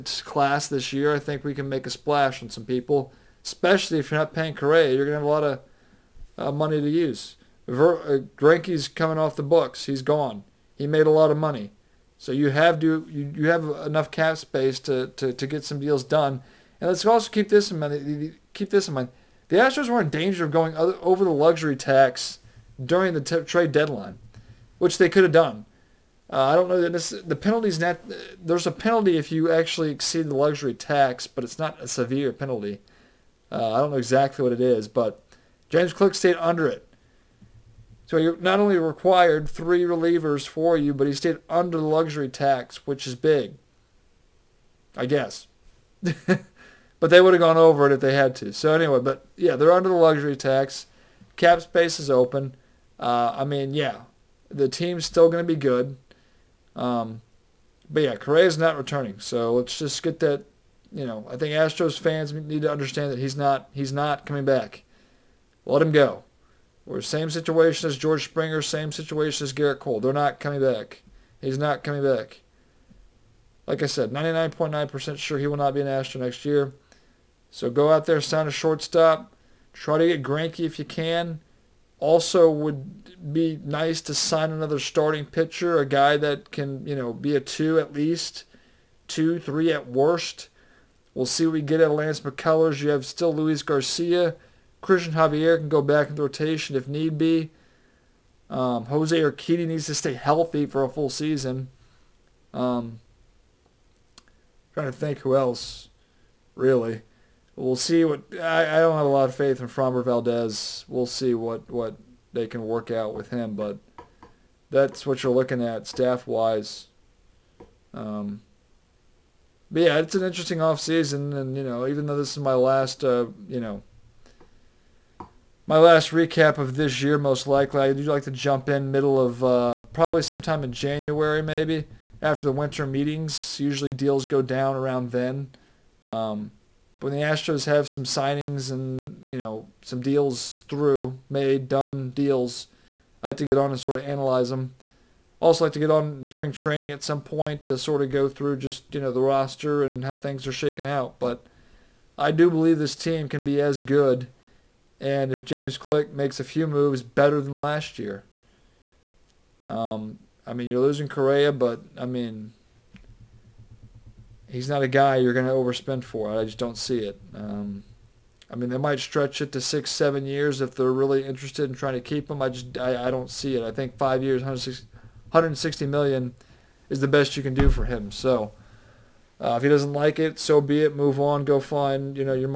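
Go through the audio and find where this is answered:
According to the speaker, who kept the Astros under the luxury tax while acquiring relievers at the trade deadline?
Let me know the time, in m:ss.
0:35.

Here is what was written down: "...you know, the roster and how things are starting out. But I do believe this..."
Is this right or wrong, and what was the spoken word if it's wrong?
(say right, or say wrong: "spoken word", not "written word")
wrong: "shaking", not "starting".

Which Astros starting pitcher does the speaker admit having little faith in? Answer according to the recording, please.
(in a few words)
Framber Valdez.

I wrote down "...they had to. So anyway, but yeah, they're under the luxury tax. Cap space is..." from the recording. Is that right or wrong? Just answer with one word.
right.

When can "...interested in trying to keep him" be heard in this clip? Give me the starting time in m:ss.
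2:51.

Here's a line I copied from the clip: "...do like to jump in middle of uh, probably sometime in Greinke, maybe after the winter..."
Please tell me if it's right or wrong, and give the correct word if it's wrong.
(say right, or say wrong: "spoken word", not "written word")
wrong: "January", not "Greinke".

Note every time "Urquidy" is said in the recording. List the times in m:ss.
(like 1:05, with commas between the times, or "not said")
1:39.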